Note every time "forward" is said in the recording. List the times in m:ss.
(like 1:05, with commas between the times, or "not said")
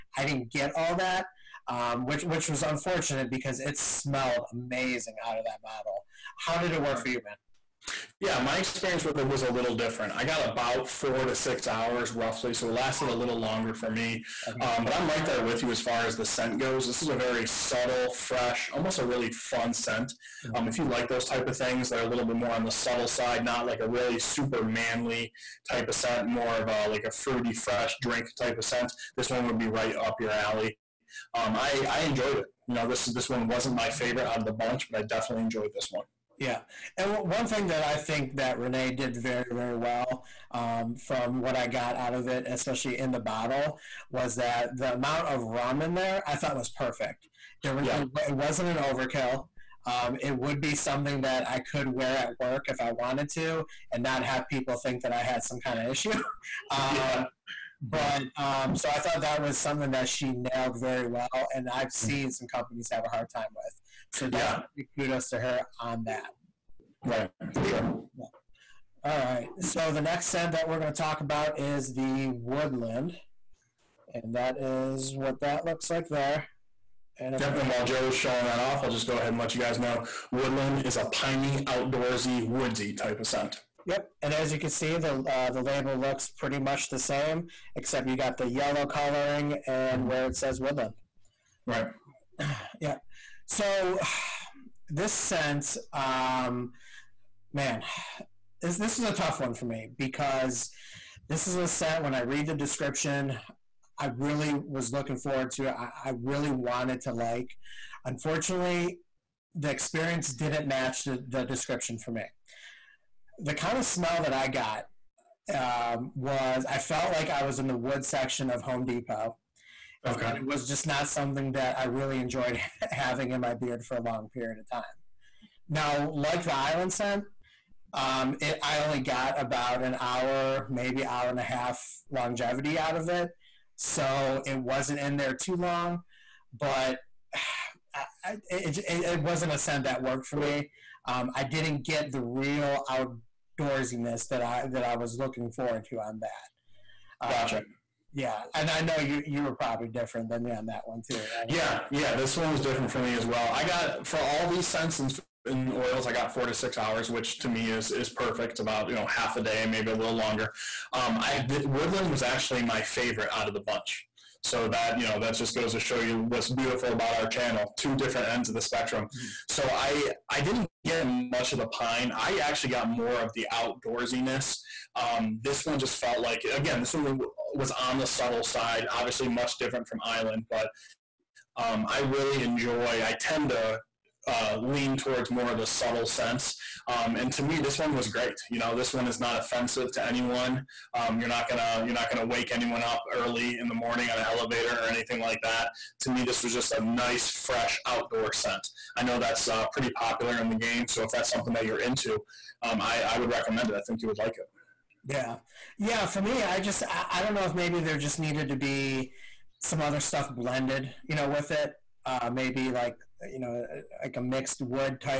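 1:45, 2:25.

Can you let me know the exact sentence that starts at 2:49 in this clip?
so i i didn't getting much of the pine.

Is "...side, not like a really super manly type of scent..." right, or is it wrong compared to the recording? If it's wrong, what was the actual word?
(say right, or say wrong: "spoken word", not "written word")
right.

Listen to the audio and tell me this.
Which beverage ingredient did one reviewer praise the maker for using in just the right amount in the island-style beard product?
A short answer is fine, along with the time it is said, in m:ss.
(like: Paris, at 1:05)
Rum, at 0:45.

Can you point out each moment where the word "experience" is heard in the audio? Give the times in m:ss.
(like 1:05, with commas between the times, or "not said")
0:08, 1:49.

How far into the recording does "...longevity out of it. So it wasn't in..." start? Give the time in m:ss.
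2:12.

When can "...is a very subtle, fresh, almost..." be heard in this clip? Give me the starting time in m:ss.
0:16.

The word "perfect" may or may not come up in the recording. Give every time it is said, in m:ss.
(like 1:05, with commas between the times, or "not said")
0:46, 2:38.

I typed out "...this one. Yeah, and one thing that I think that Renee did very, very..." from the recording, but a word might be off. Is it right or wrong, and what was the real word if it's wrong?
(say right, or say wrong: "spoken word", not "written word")
right.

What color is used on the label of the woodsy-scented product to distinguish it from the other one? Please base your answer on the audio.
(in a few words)
Yellow.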